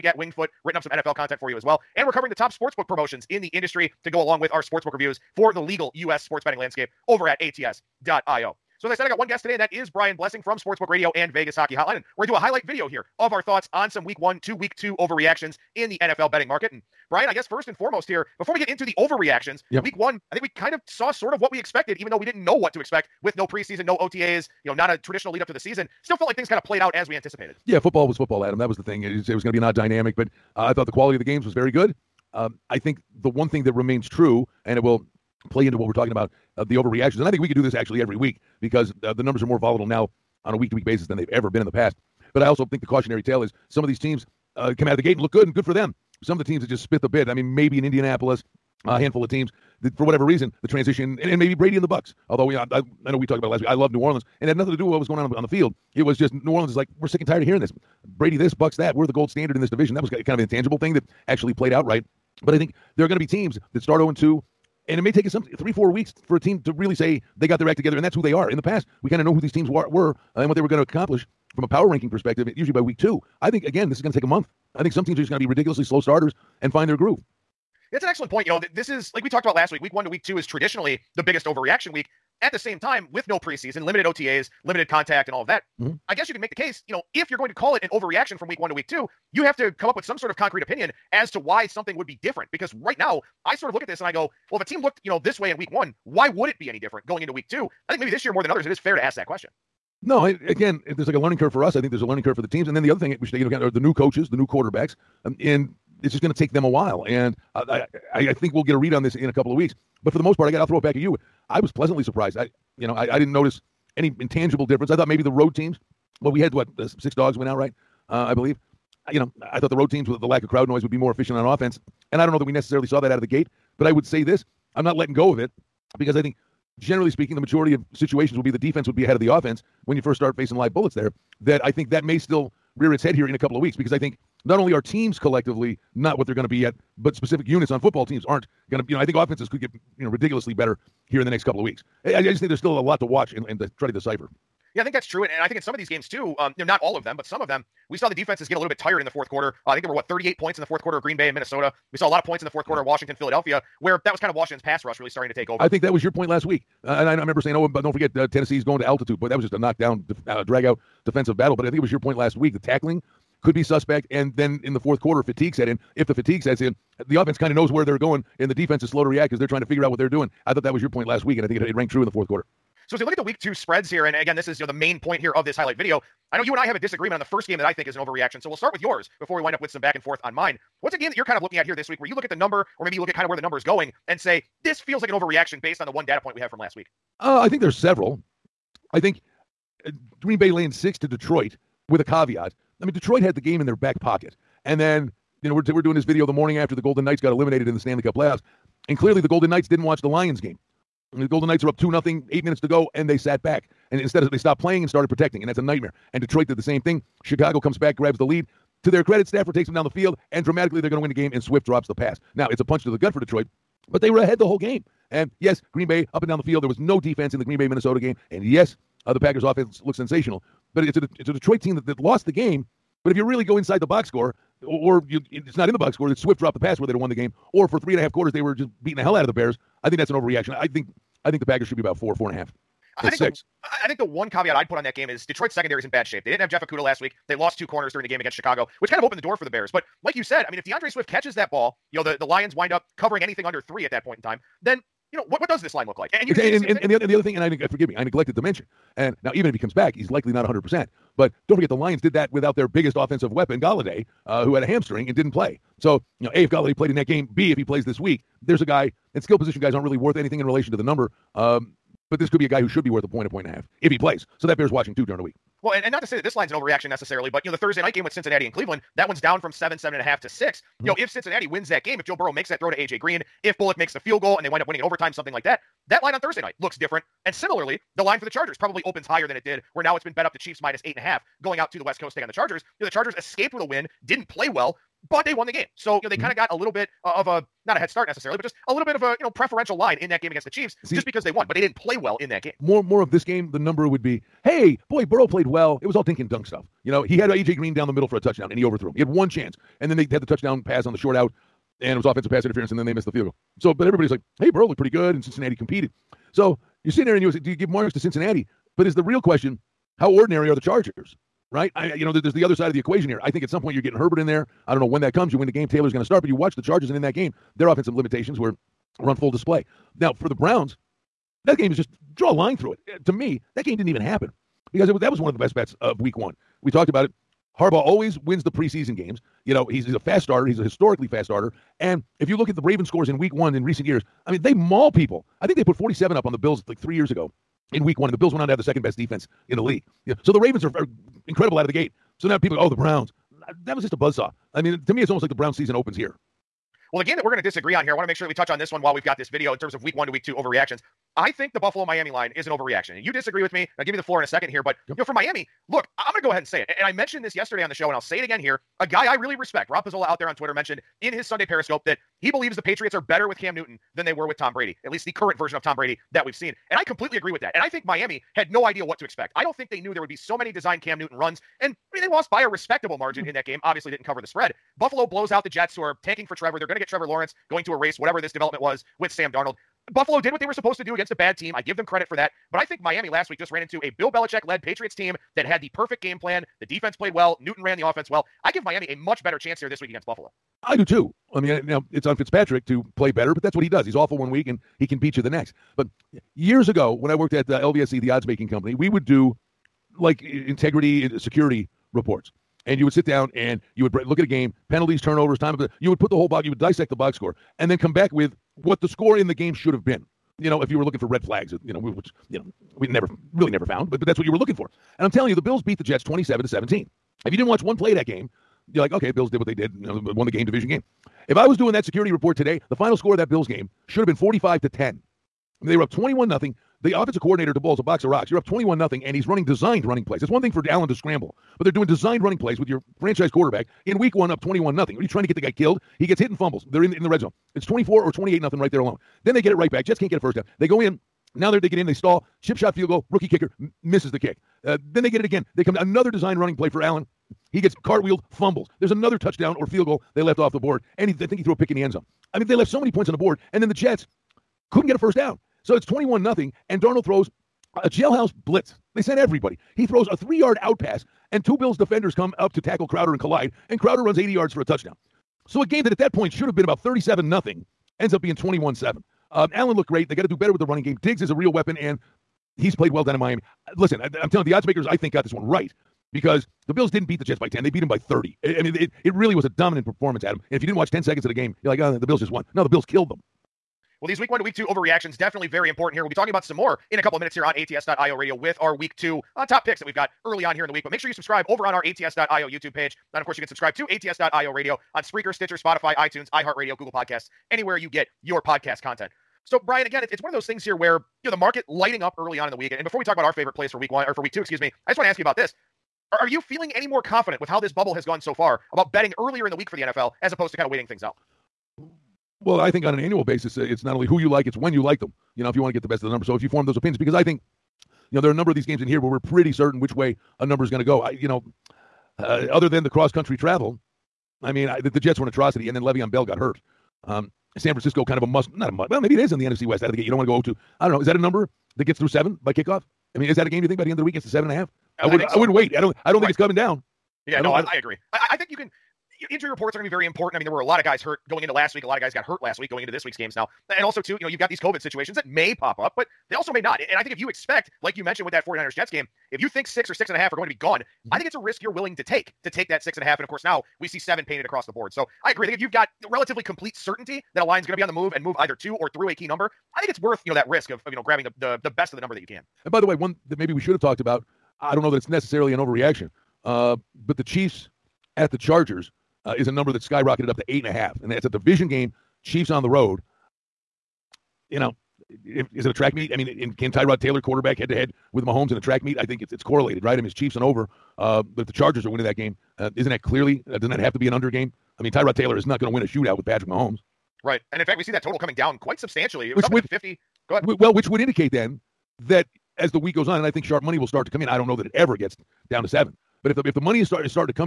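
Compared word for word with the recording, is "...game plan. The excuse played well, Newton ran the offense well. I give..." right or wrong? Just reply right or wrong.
wrong.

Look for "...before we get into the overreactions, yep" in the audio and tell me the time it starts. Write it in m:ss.
0:18.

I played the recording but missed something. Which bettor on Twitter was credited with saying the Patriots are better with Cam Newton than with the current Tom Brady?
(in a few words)
Rob Pizzola.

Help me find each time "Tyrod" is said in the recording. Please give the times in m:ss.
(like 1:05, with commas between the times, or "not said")
9:36, 9:44.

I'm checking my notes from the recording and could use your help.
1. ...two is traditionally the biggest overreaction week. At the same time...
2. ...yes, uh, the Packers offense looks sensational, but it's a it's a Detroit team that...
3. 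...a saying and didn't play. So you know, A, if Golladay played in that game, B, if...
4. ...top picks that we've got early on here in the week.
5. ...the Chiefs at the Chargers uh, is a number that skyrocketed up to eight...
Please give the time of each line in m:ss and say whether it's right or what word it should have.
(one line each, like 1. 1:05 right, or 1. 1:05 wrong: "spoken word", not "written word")
1. 1:20 right
2. 3:38 right
3. 4:14 wrong: "hamstring", not "saying"
4. 8:09 right
5. 9:27 right.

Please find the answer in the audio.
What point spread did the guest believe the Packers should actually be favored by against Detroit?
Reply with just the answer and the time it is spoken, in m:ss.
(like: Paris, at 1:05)
4.5, at 3:51.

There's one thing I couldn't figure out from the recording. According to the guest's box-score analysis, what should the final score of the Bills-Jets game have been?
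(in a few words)
45 to 10.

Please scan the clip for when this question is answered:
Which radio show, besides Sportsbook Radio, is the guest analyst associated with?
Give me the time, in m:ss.
0:11.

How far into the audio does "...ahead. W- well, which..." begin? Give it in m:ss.
9:50.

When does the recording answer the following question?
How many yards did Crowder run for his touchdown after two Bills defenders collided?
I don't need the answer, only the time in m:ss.
7:44.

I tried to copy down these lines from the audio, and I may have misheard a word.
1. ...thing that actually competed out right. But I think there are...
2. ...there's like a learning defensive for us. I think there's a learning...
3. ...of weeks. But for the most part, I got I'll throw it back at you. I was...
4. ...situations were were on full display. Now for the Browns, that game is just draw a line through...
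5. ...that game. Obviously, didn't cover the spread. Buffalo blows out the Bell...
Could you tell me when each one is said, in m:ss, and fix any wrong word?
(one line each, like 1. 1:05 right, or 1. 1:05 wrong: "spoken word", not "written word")
1. 1:00 wrong: "played", not "competed"
2. 1:40 wrong: "curve", not "defensive"
3. 1:49 right
4. 5:17 wrong: "limitations", not "situations"
5. 6:13 wrong: "Jets", not "Bell".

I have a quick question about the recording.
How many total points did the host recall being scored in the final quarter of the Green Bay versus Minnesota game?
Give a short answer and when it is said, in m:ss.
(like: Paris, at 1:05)
38, at 2:30.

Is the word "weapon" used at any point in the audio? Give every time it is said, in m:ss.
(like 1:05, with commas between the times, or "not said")
4:13, 7:51.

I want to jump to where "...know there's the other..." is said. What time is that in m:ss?
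5:12.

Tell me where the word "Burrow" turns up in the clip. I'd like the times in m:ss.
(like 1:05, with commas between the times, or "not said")
4:32, 4:55, 5:04.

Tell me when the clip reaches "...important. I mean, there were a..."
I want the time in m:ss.
9:00.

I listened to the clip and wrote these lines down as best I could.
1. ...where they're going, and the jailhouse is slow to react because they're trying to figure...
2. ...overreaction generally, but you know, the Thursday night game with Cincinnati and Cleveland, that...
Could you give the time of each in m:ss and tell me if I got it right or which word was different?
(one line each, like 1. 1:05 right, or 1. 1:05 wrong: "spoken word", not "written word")
1. 2:47 wrong: "defense", not "jailhouse"
2. 4:26 wrong: "necessarily", not "generally".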